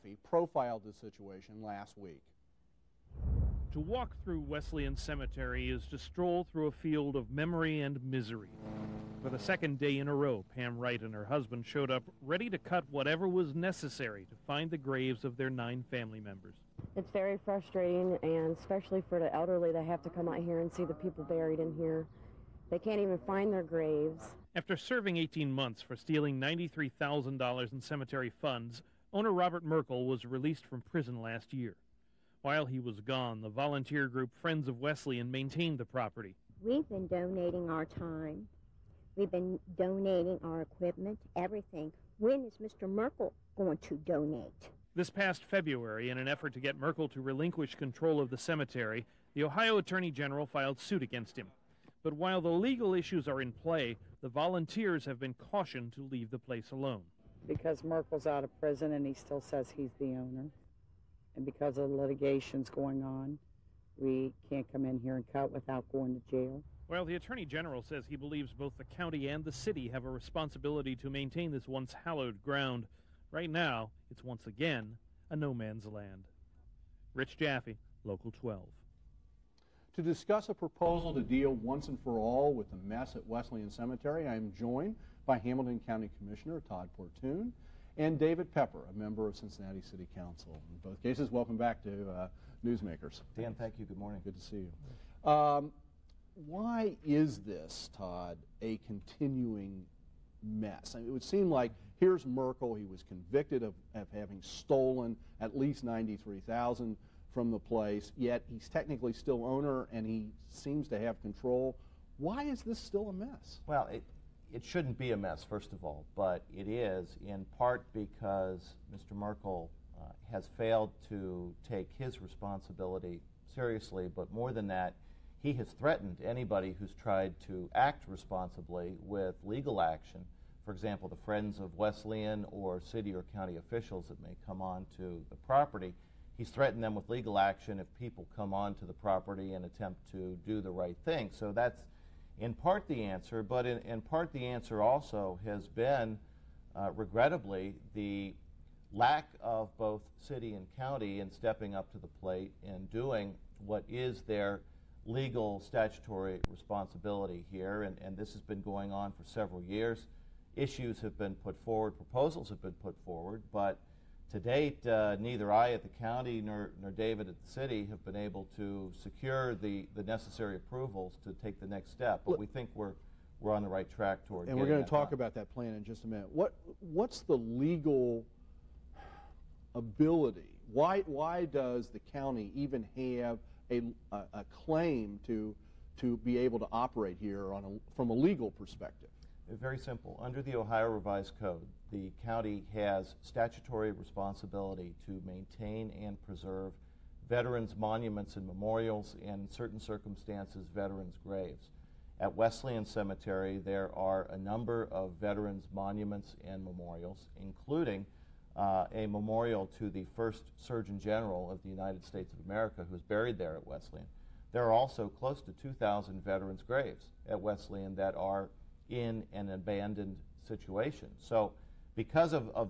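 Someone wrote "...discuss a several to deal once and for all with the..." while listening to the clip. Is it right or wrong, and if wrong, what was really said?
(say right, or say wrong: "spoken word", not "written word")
wrong: "proposal", not "several".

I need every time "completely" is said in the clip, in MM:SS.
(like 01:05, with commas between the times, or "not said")
not said.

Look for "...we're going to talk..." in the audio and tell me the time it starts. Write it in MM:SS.
02:54.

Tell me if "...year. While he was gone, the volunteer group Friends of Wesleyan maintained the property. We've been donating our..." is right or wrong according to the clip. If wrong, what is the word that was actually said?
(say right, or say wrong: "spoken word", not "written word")
right.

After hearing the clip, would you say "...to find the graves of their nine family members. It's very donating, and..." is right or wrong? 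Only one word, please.
wrong.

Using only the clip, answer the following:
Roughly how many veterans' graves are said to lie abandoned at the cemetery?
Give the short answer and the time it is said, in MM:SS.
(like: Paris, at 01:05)
2,000, at 03:35.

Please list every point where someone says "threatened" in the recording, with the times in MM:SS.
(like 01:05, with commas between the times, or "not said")
02:05, 02:16.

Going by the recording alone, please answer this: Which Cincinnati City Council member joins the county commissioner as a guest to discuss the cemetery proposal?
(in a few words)
David Pepper.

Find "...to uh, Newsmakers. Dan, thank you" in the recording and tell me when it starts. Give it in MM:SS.
01:31.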